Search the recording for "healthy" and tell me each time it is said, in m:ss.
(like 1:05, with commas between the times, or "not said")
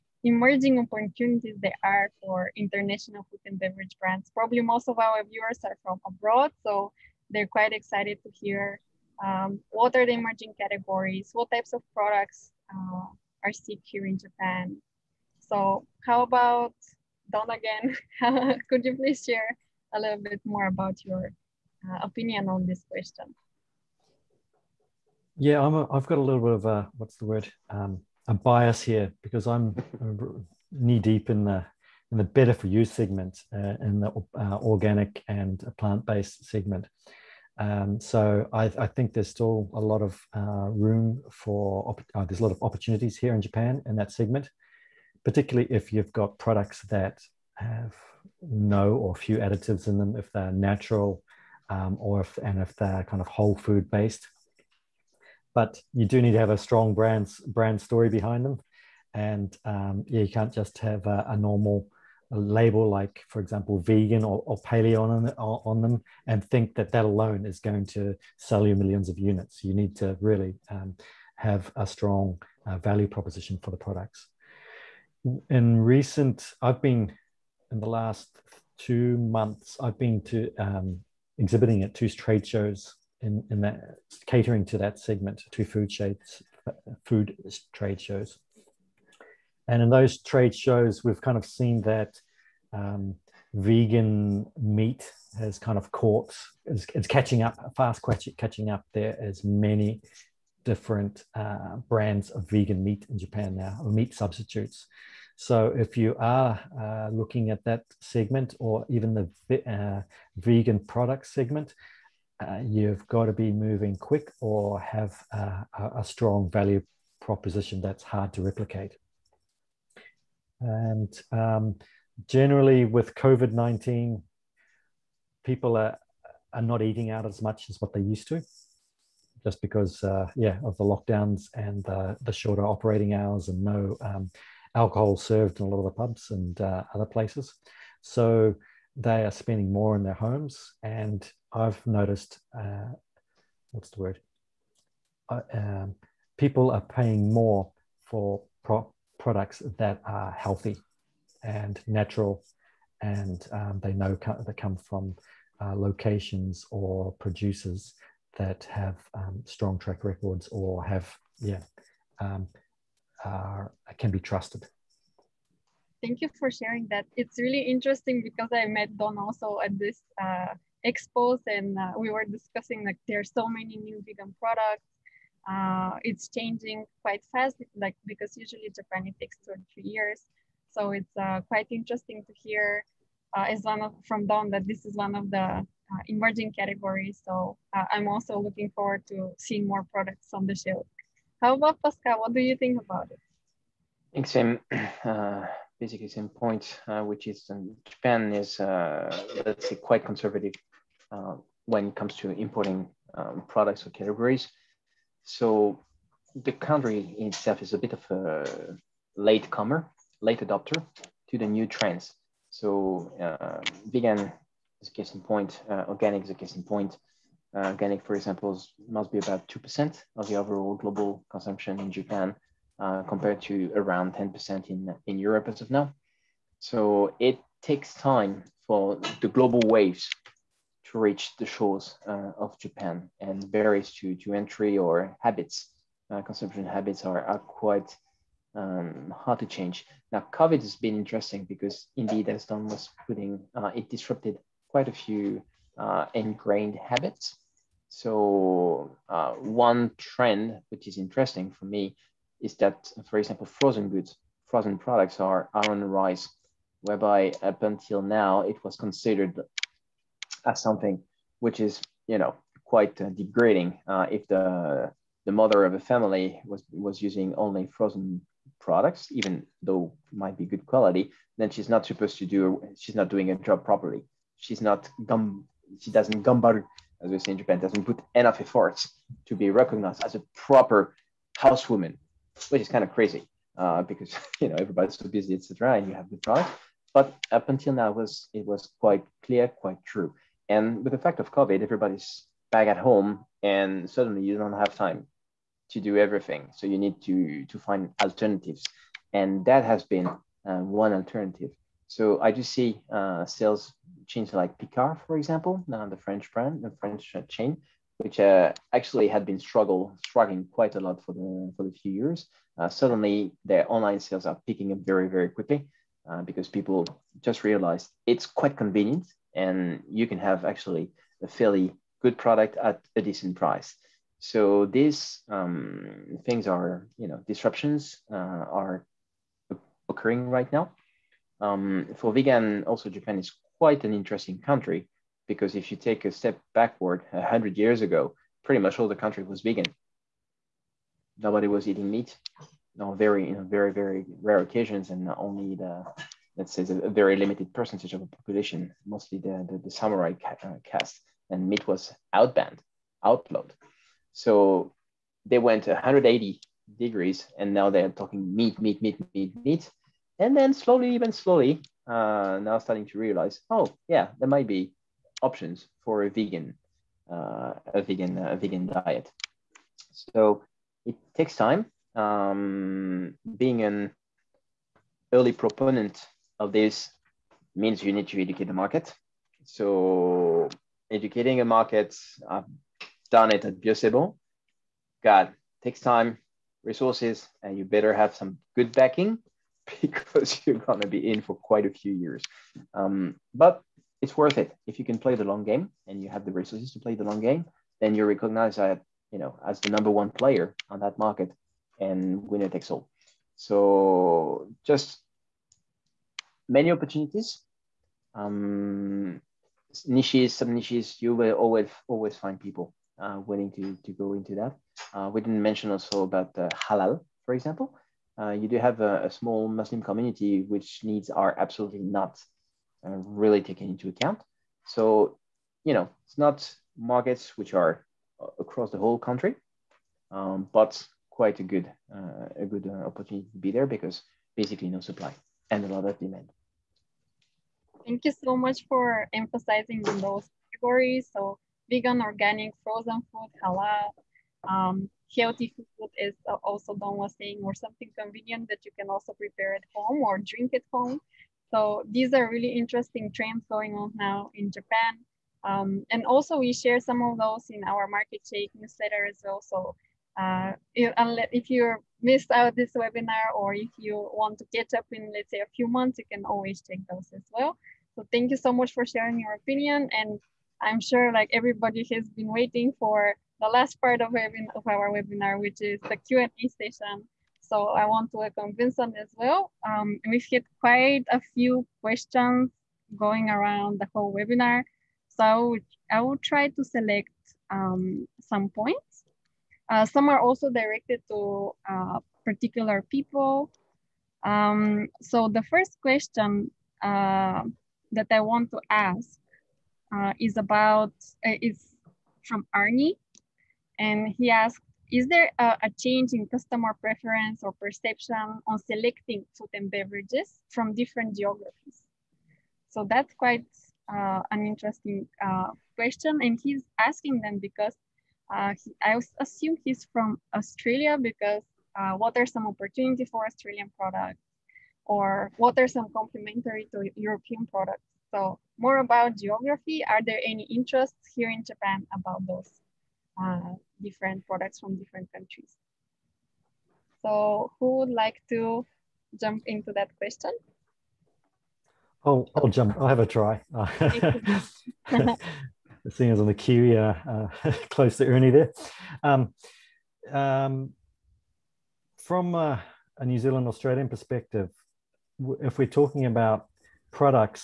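2:30, 7:25.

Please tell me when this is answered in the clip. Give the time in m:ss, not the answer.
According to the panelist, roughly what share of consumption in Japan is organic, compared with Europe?
3:39.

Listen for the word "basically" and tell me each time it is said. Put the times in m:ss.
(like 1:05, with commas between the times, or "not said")
3:15, 7:14.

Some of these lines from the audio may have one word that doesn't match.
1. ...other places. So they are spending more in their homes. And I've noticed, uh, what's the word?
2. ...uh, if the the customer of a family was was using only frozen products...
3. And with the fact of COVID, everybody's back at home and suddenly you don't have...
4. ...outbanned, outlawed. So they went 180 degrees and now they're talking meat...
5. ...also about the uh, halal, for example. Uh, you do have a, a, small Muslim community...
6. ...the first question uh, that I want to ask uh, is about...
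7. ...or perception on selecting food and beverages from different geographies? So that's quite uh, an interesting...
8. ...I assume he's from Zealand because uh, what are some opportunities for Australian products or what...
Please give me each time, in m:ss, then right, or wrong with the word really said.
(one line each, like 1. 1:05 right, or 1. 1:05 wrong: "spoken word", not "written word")
1. 2:16 right
2. 4:23 wrong: "mother", not "customer"
3. 4:50 right
4. 5:52 right
5. 6:55 right
6. 8:15 right
7. 8:27 right
8. 8:38 wrong: "Australia", not "Zealand".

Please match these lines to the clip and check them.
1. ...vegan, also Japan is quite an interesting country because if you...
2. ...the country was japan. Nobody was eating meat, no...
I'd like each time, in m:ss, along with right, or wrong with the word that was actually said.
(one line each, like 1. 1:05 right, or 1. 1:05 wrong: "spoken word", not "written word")
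1. 5:32 right
2. 5:38 wrong: "vegan", not "japan".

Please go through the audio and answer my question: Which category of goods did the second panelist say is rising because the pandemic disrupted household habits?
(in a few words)
frozen goods.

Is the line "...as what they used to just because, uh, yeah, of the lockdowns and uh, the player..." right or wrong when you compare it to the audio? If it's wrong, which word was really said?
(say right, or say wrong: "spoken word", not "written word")
wrong: "shorter", not "player".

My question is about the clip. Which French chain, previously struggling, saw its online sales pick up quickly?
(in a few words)
Picard.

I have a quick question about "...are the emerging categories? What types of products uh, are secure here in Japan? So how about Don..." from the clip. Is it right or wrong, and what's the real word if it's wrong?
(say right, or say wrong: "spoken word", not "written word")
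right.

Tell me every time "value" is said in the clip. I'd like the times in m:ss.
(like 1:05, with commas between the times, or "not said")
1:12, 1:56.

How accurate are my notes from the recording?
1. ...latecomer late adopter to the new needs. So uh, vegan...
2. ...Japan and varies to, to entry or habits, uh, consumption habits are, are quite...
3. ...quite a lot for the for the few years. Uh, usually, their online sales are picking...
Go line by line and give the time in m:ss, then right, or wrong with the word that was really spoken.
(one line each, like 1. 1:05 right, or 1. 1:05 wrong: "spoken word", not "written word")
1. 3:29 wrong: "trends", not "needs"
2. 3:52 right
3. 5:10 wrong: "suddenly", not "usually".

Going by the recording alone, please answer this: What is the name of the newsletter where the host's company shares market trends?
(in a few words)
Market Shake.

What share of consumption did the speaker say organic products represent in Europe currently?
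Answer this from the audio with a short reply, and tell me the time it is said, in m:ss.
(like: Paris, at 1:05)
around 10%, at 3:43.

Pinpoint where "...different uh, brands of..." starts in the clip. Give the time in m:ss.
1:40.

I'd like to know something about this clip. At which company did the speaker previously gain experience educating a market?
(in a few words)
Bio c' Bon.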